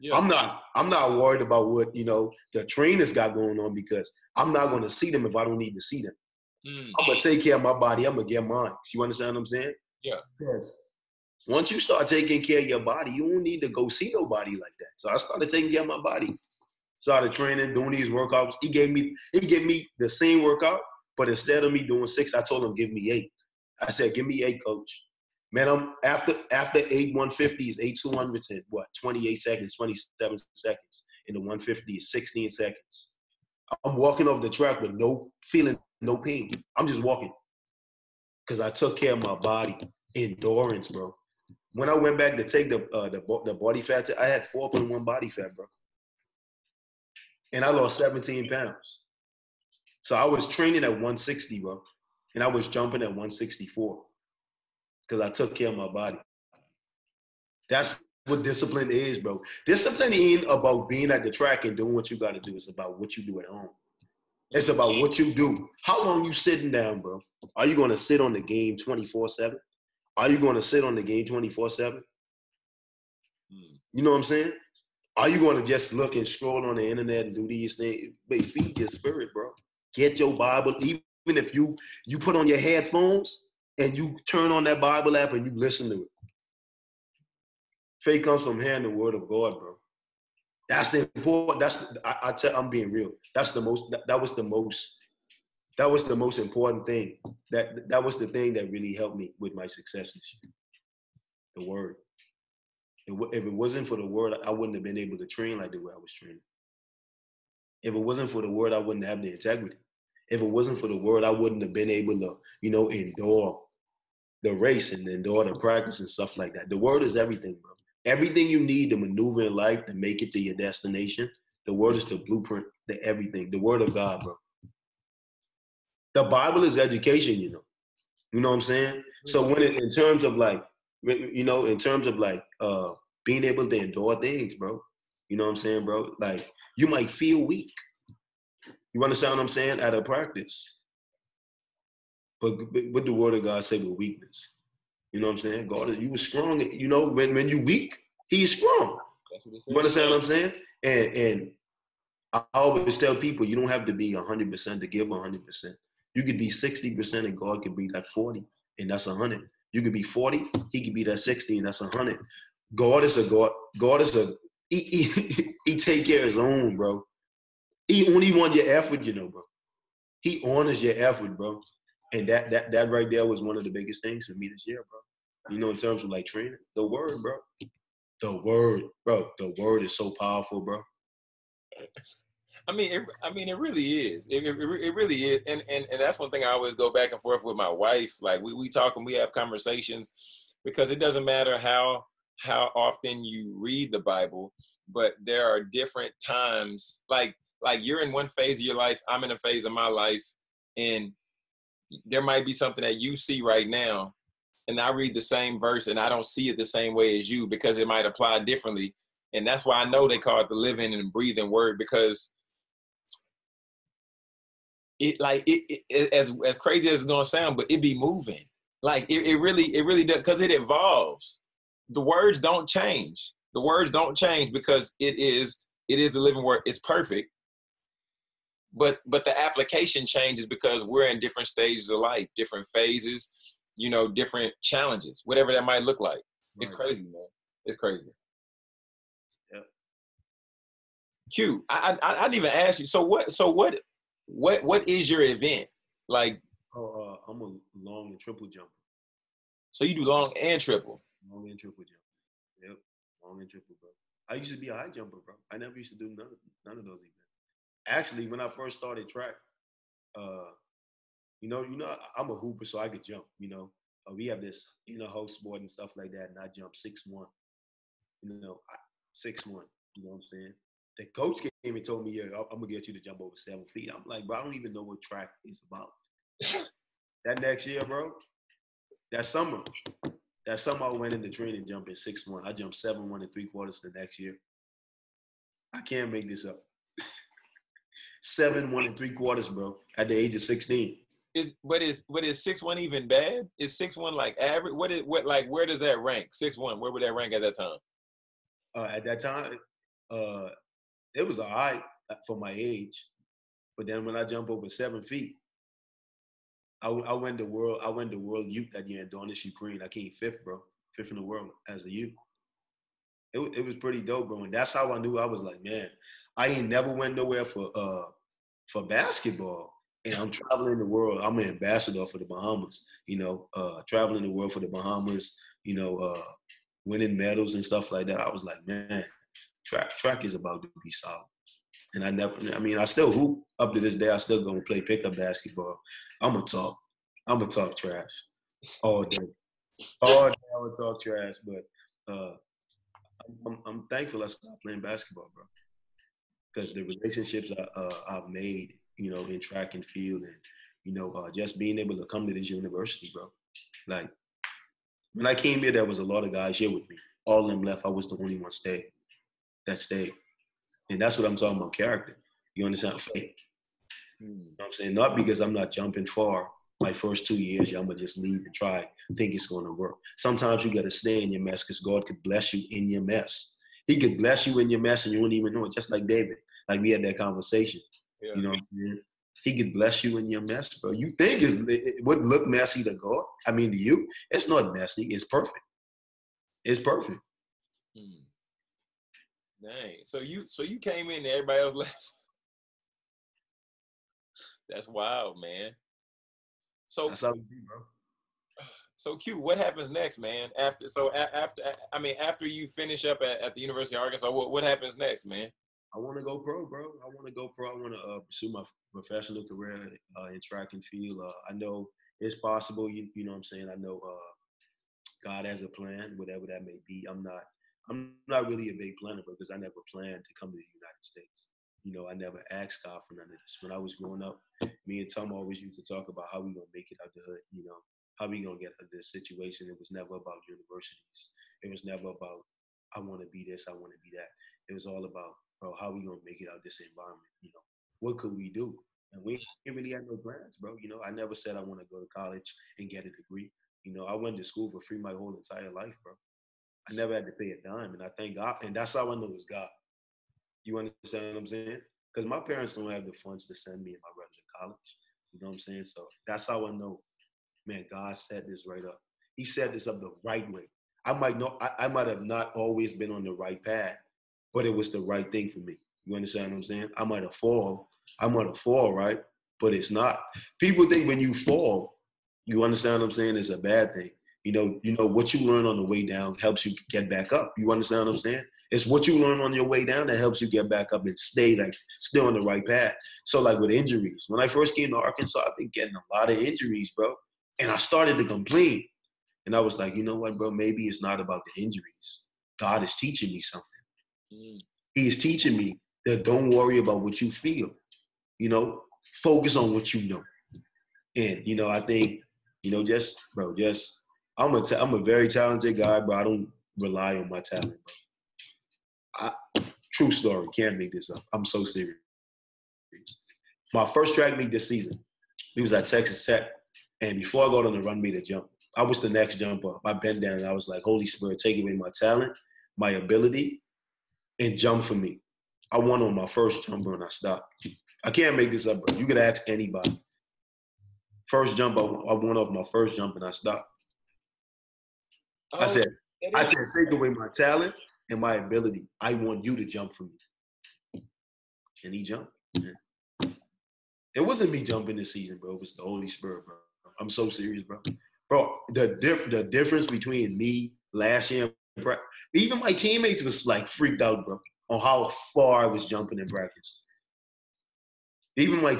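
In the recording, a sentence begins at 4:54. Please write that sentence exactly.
What is what like where does that rank?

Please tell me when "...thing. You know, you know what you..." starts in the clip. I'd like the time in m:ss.
7:53.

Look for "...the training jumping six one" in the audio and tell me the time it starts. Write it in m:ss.
4:41.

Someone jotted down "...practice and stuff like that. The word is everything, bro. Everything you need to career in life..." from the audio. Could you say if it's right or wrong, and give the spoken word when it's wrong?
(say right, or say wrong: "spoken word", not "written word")
wrong: "maneuver", not "career".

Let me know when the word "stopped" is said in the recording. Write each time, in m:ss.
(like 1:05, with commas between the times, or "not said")
5:44, 8:47, 8:53.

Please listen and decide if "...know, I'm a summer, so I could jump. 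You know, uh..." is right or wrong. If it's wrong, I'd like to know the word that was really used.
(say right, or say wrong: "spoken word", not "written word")
wrong: "hooper", not "summer".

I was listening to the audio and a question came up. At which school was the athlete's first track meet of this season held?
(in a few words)
Texas Tech.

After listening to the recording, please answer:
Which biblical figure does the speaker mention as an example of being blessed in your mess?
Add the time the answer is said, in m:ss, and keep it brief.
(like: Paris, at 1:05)
David, at 6:16.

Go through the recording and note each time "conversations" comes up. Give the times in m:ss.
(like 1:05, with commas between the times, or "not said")
3:09, 6:17.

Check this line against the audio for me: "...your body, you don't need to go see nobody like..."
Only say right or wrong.
right.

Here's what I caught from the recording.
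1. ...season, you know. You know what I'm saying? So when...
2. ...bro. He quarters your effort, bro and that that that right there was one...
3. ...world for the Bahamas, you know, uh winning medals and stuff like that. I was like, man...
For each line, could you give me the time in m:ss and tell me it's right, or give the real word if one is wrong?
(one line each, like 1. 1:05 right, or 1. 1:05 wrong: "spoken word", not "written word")
1. 2:06 wrong: "education", not "season"
2. 2:49 wrong: "honors", not "quarters"
3. 5:24 right.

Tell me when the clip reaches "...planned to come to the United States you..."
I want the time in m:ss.
6:59.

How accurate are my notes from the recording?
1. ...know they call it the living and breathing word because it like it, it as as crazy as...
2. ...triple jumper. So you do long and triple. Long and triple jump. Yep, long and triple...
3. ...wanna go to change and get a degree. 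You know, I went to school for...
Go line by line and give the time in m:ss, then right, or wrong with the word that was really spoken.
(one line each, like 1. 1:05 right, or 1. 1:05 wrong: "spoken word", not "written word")
1. 3:29 right
2. 4:08 right
3. 7:21 wrong: "college", not "change".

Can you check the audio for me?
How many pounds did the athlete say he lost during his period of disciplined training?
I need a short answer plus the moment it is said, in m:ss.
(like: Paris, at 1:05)
17, at 0:47.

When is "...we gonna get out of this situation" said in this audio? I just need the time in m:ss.
7:08.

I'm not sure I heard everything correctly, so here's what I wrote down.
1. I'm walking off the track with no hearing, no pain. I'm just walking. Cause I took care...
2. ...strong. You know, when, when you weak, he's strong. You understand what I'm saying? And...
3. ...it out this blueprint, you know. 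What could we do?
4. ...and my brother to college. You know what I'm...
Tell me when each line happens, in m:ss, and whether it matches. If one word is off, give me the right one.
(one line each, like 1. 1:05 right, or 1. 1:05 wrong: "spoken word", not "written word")
1. 0:33 wrong: "feeling", not "hearing"
2. 2:26 right
3. 7:16 wrong: "environment", not "blueprint"
4. 7:33 right.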